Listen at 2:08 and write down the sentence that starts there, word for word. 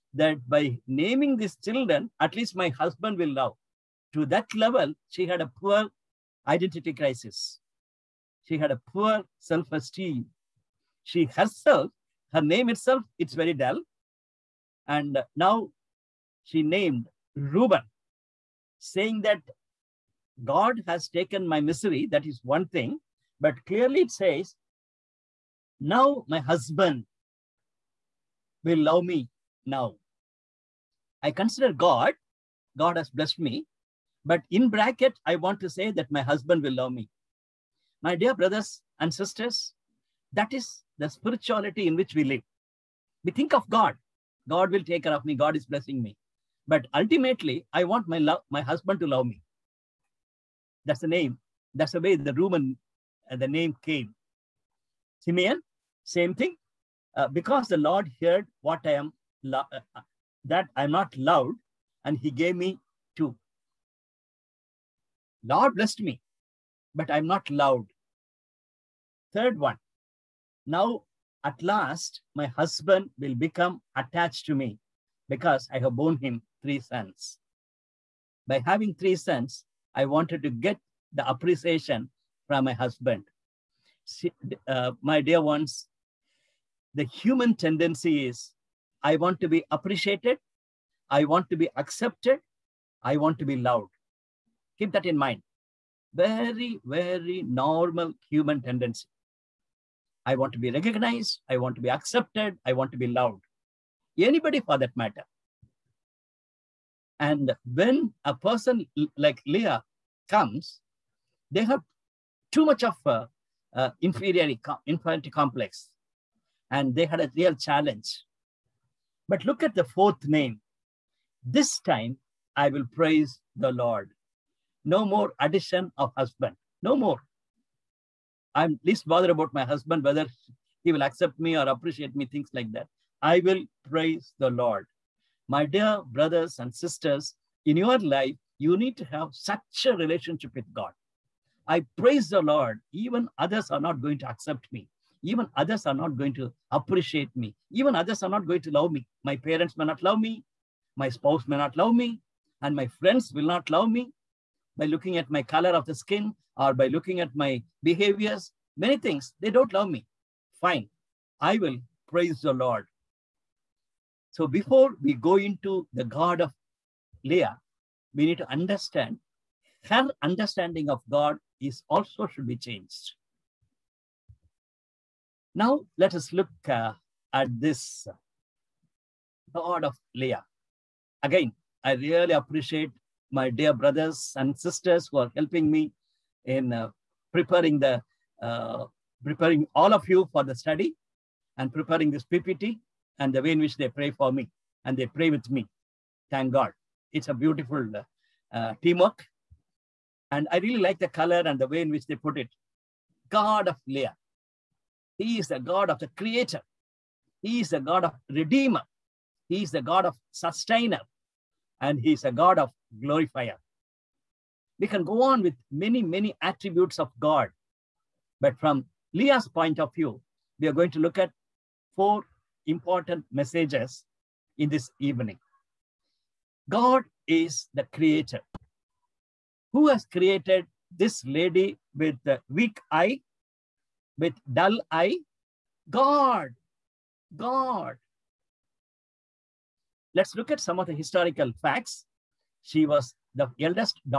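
I'm least bothered about my husband, whether he will accept me or appreciate me, things like that.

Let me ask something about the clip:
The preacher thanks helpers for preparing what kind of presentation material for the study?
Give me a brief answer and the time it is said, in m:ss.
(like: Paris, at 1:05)
PPT, at 3:12.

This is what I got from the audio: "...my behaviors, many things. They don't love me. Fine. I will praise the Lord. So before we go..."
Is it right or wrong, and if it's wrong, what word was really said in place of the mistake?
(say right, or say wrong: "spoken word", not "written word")
right.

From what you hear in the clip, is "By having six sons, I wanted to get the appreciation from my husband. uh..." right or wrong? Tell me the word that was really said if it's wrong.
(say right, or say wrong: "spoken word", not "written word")
wrong: "three", not "six".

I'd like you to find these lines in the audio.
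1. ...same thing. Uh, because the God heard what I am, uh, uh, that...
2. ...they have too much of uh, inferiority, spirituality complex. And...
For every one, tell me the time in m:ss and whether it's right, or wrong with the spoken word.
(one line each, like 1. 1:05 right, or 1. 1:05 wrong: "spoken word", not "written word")
1. 0:56 wrong: "Lord", not "God"
2. 1:51 wrong: "inferiority", not "spirituality".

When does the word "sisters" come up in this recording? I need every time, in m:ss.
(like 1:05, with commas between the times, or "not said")
0:39, 2:16, 3:04.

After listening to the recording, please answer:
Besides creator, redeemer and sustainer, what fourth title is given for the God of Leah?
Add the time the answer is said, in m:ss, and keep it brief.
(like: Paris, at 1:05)
Glorifier, at 3:33.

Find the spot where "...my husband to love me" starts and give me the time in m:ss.
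0:48.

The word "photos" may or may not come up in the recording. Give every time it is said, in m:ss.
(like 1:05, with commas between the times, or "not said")
not said.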